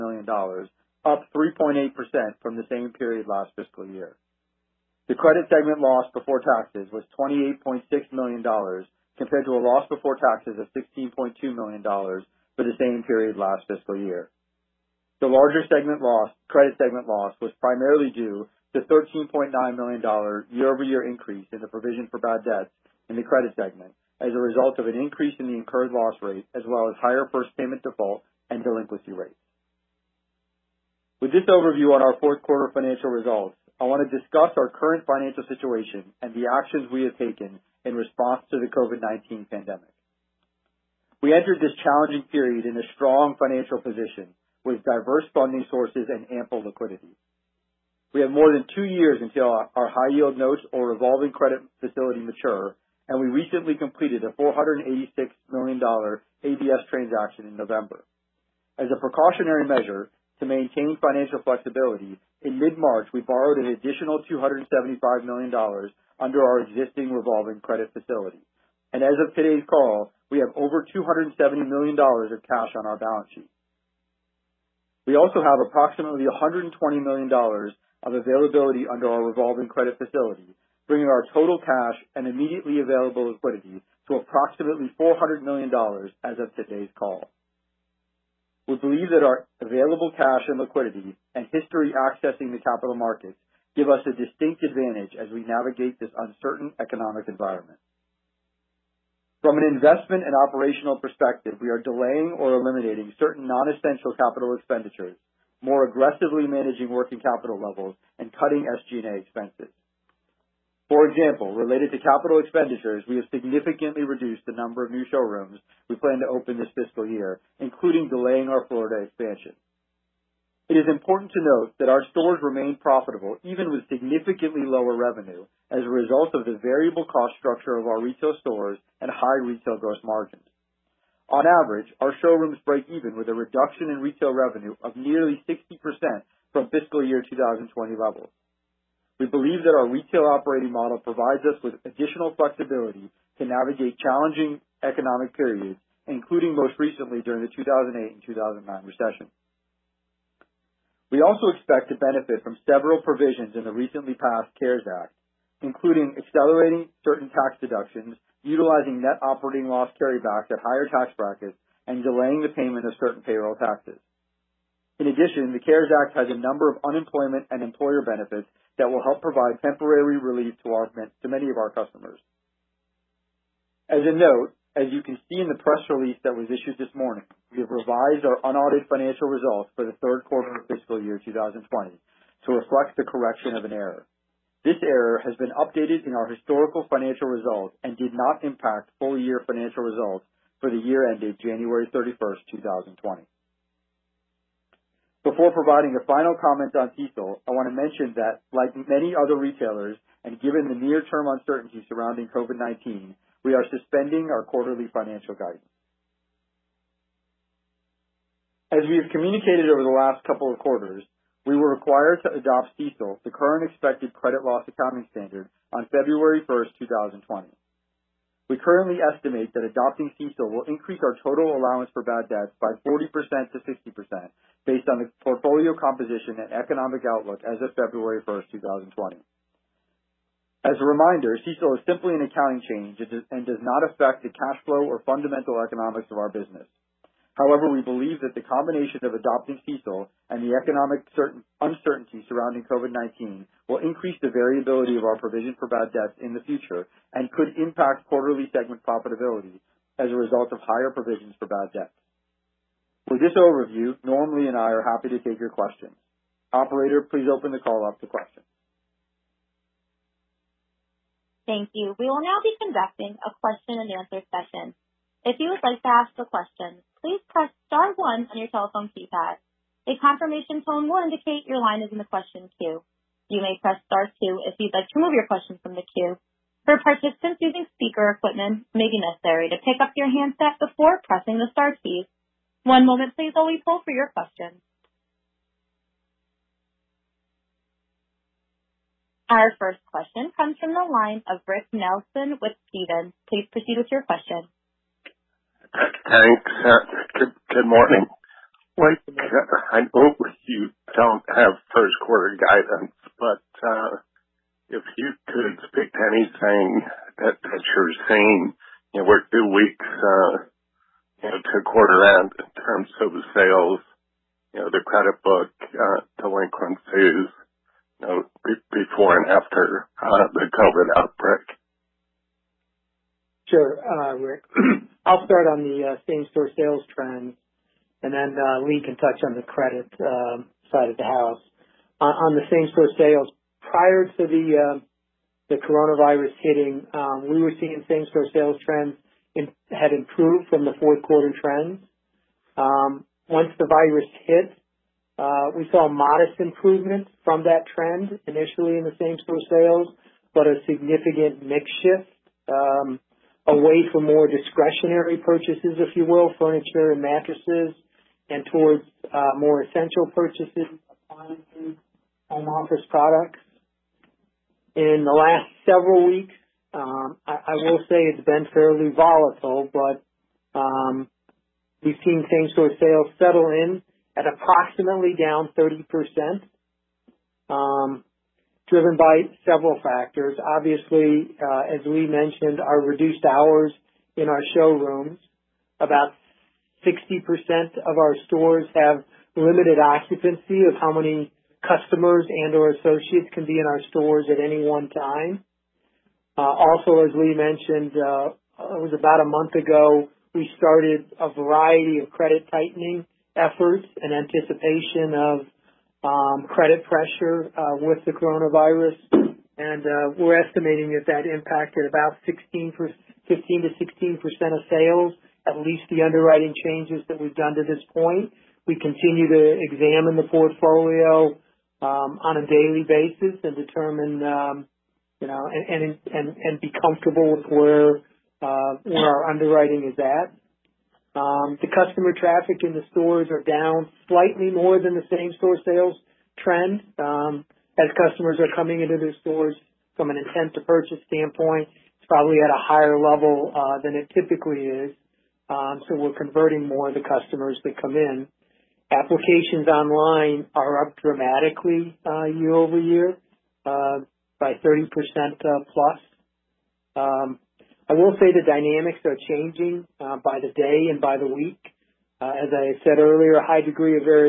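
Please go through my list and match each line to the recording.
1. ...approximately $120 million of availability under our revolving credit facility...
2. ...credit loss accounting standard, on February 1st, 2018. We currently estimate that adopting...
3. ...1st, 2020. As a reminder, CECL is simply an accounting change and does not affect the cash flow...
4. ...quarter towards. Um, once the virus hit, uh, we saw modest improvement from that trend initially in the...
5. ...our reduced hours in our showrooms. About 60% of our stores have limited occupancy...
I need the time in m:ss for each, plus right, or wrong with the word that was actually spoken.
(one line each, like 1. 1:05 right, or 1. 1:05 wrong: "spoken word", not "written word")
1. 1:15 right
2. 3:34 wrong: "2020", not "2018"
3. 3:48 right
4. 5:41 wrong: "trends", not "towards"
5. 6:22 right.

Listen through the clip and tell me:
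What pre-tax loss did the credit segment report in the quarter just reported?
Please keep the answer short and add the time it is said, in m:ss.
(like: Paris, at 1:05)
$28.6 million, at 0:07.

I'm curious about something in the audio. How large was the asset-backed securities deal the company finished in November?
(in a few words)
$486 million.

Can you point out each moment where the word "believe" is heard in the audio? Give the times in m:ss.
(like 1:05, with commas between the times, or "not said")
1:28, 2:19, 3:57.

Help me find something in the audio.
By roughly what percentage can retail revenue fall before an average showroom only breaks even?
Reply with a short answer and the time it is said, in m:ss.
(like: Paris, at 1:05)
60%, at 2:14.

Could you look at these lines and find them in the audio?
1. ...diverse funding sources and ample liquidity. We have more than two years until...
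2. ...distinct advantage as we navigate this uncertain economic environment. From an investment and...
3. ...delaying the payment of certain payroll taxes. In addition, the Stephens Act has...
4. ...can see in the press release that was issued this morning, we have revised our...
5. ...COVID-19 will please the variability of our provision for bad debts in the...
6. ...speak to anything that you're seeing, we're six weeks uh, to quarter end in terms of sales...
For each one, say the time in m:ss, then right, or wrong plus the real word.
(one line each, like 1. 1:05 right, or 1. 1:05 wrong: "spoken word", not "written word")
1. 0:44 right
2. 1:34 right
3. 2:42 wrong: "CARES", not "Stephens"
4. 2:55 right
5. 4:02 wrong: "increase", not "please"
6. 5:05 wrong: "two", not "six".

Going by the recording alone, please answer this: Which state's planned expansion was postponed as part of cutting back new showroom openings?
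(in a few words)
Florida.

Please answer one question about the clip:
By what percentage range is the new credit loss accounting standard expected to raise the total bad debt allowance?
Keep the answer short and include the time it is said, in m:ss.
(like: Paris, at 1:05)
40%-60%, at 3:42.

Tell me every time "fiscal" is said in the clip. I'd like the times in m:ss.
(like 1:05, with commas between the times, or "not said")
0:03, 0:13, 1:56, 2:16, 3:00.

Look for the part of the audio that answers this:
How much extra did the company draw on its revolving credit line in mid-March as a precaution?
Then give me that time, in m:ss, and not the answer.
1:04.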